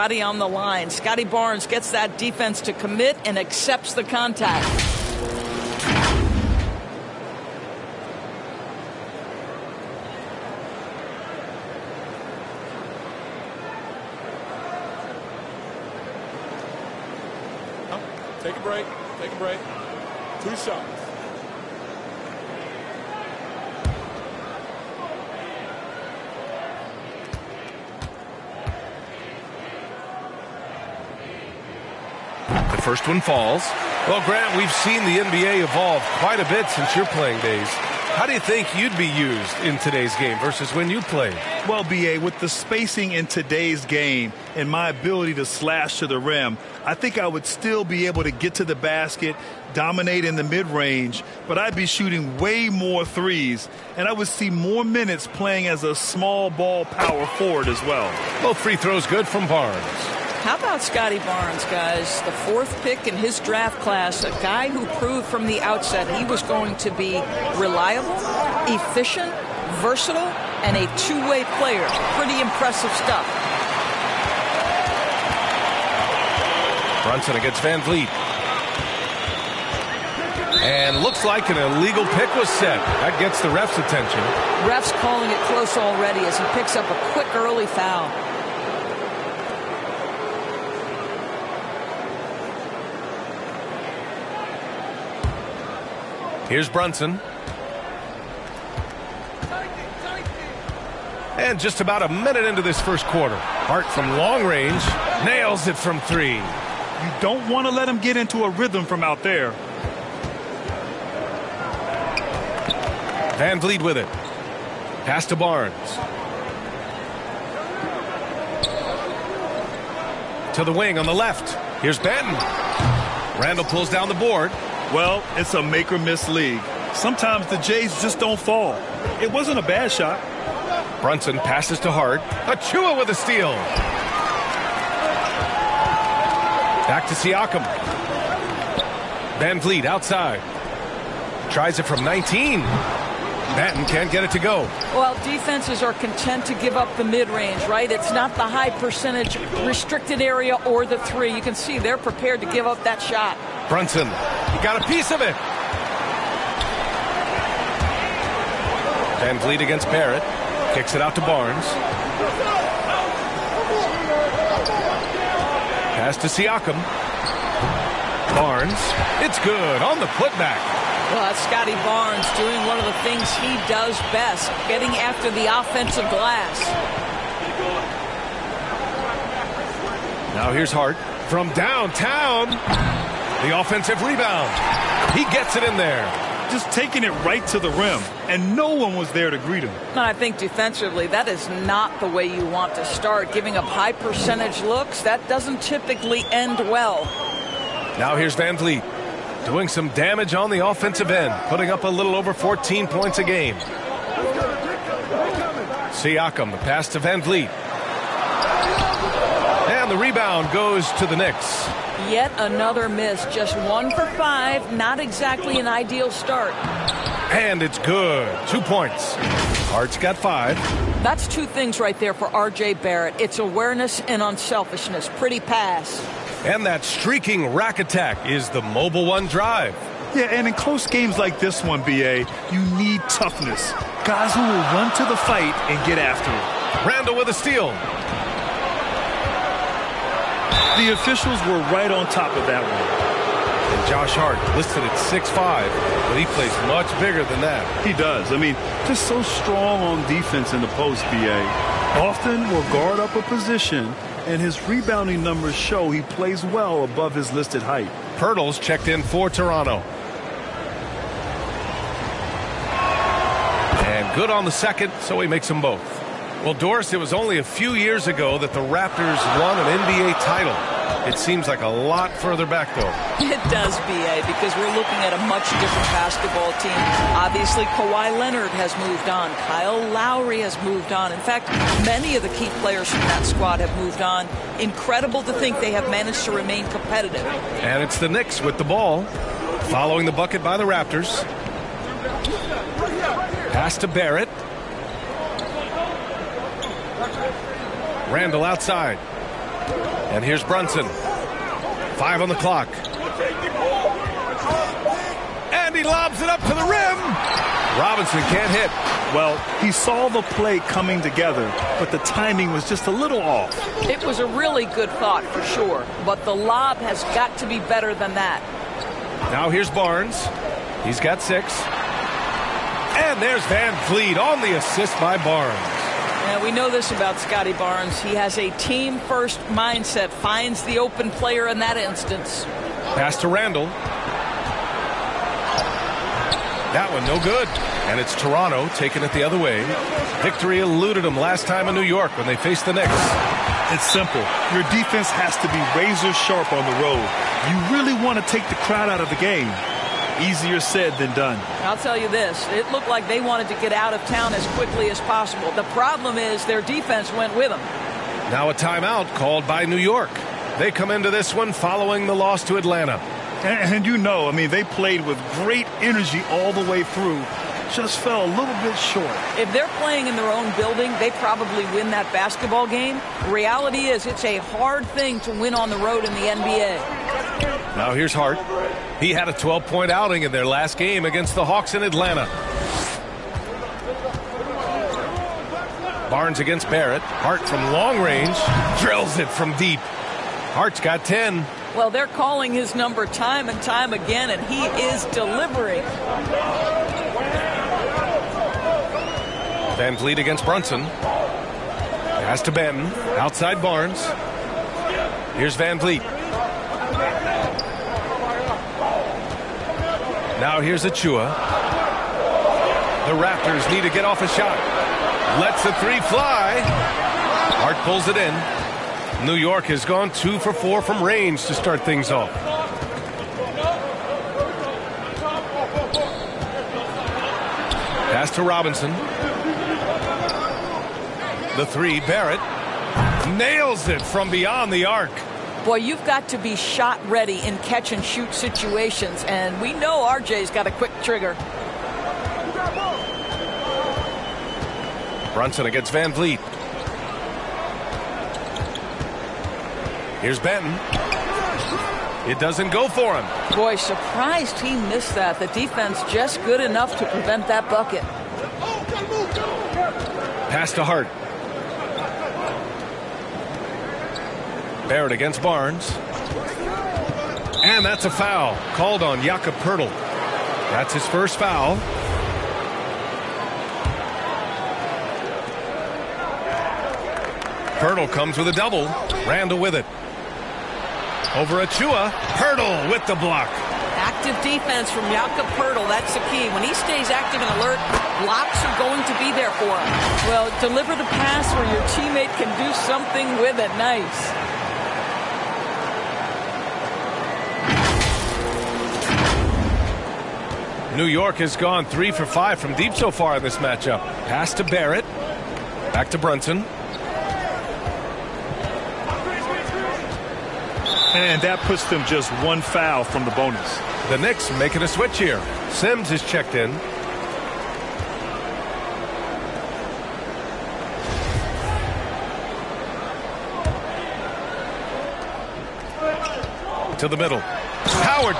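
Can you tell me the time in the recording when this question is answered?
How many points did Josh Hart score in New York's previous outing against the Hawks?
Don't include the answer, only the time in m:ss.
6:19.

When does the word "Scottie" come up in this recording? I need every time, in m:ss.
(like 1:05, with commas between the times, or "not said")
0:00, 1:00, 2:51, 5:27.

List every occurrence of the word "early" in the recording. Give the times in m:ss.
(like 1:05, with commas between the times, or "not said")
1:27.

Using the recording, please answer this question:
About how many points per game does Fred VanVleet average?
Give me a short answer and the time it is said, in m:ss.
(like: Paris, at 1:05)
14, at 3:22.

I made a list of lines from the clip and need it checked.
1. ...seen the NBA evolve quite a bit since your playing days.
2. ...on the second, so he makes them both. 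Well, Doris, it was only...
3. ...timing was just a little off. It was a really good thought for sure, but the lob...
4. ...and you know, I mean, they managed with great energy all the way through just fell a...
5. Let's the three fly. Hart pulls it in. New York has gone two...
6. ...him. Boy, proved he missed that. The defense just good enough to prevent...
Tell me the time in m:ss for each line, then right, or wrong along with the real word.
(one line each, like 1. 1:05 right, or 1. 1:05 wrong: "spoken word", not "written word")
1. 0:34 right
2. 4:24 right
3. 5:11 right
4. 6:03 wrong: "played", not "managed"
5. 6:55 right
6. 7:33 wrong: "surprised", not "proved".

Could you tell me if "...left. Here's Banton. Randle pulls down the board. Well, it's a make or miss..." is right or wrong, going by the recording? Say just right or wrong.
right.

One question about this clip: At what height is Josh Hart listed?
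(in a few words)
6'5".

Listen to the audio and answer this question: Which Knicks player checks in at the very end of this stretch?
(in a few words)
Sims.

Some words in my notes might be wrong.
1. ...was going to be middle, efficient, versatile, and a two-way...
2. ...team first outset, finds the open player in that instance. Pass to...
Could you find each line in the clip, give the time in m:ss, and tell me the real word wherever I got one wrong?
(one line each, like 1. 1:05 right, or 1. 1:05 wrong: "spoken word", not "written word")
1. 1:06 wrong: "reliable", not "middle"
2. 5:28 wrong: "mindset", not "outset".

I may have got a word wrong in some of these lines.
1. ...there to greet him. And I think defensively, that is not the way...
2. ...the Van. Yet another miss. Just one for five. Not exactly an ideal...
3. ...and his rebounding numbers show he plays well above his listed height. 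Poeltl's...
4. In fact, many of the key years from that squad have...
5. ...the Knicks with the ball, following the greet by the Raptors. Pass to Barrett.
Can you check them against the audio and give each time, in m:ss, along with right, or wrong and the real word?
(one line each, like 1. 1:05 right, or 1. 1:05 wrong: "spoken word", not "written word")
1. 3:09 right
2. 3:31 wrong: "Knicks", not "Van"
3. 4:14 right
4. 4:41 wrong: "players", not "years"
5. 4:47 wrong: "bucket", not "greet".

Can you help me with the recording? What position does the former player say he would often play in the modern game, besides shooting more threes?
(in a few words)
Small ball power forward.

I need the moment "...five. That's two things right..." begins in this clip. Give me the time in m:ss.
3:40.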